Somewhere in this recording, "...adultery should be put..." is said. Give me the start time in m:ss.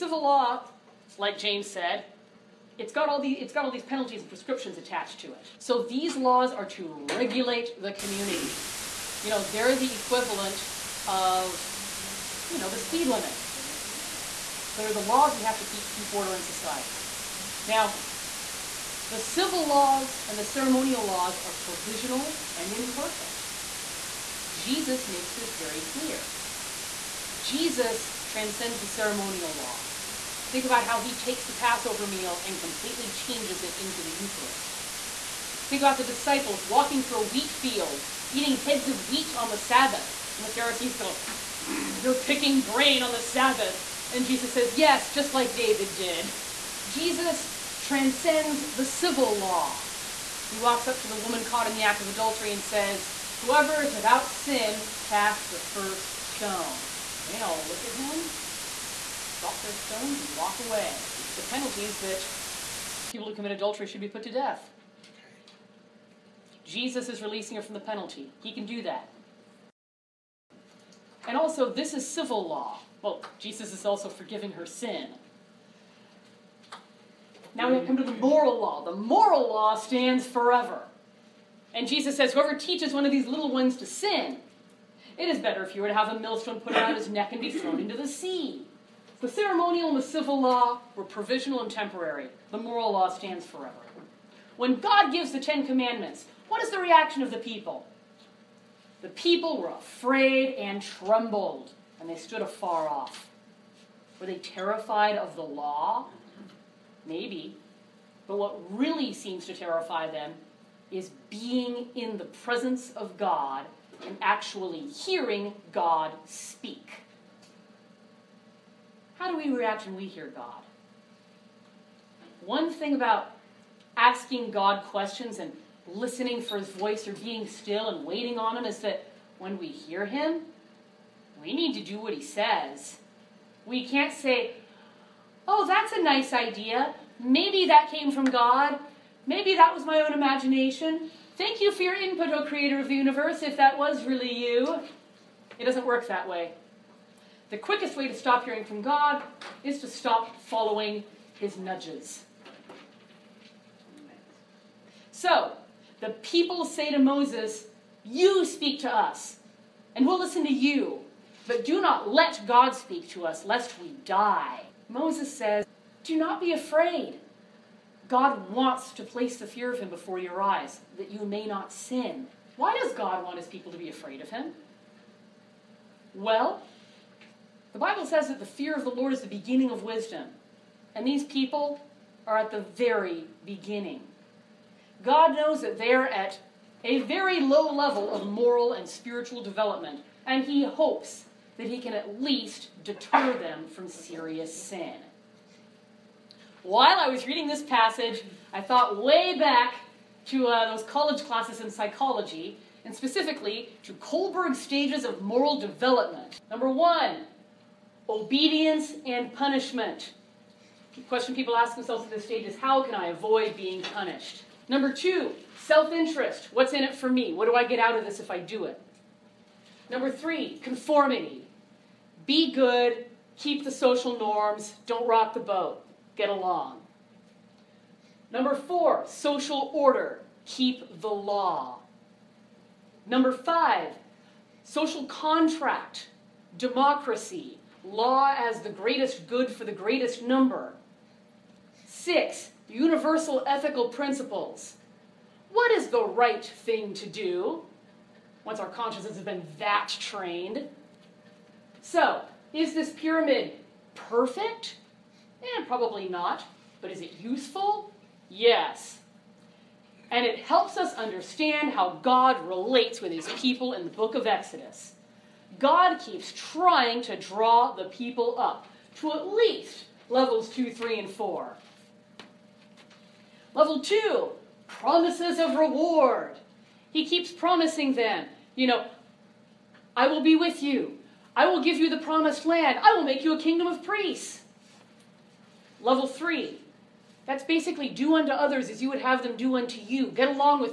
1:03.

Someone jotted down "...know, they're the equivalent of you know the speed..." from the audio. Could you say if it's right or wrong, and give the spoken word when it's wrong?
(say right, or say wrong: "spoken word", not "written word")
right.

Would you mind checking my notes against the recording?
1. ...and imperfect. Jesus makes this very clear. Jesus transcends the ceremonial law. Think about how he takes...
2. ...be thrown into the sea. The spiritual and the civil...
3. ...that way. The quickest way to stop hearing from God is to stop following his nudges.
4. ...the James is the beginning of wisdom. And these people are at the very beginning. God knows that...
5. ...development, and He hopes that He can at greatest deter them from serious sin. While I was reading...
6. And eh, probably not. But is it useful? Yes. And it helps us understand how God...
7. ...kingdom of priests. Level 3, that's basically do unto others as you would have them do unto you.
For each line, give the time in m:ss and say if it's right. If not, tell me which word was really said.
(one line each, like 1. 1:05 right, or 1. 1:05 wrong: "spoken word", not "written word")
1. 0:22 right
2. 1:27 wrong: "ceremonial", not "spiritual"
3. 2:26 right
4. 2:58 wrong: "Lord", not "James"
5. 3:09 wrong: "least", not "greatest"
6. 4:15 right
7. 4:43 right.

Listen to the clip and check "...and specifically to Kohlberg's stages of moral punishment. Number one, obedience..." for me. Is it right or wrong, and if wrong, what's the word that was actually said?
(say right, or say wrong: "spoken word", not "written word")
wrong: "development", not "punishment".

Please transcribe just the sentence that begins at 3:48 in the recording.
Number four, social order, keep the law.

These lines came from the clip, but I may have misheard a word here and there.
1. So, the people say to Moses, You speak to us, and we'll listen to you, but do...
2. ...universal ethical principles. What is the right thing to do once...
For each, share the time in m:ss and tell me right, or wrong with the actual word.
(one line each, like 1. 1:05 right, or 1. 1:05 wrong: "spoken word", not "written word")
1. 2:35 right
2. 4:02 right.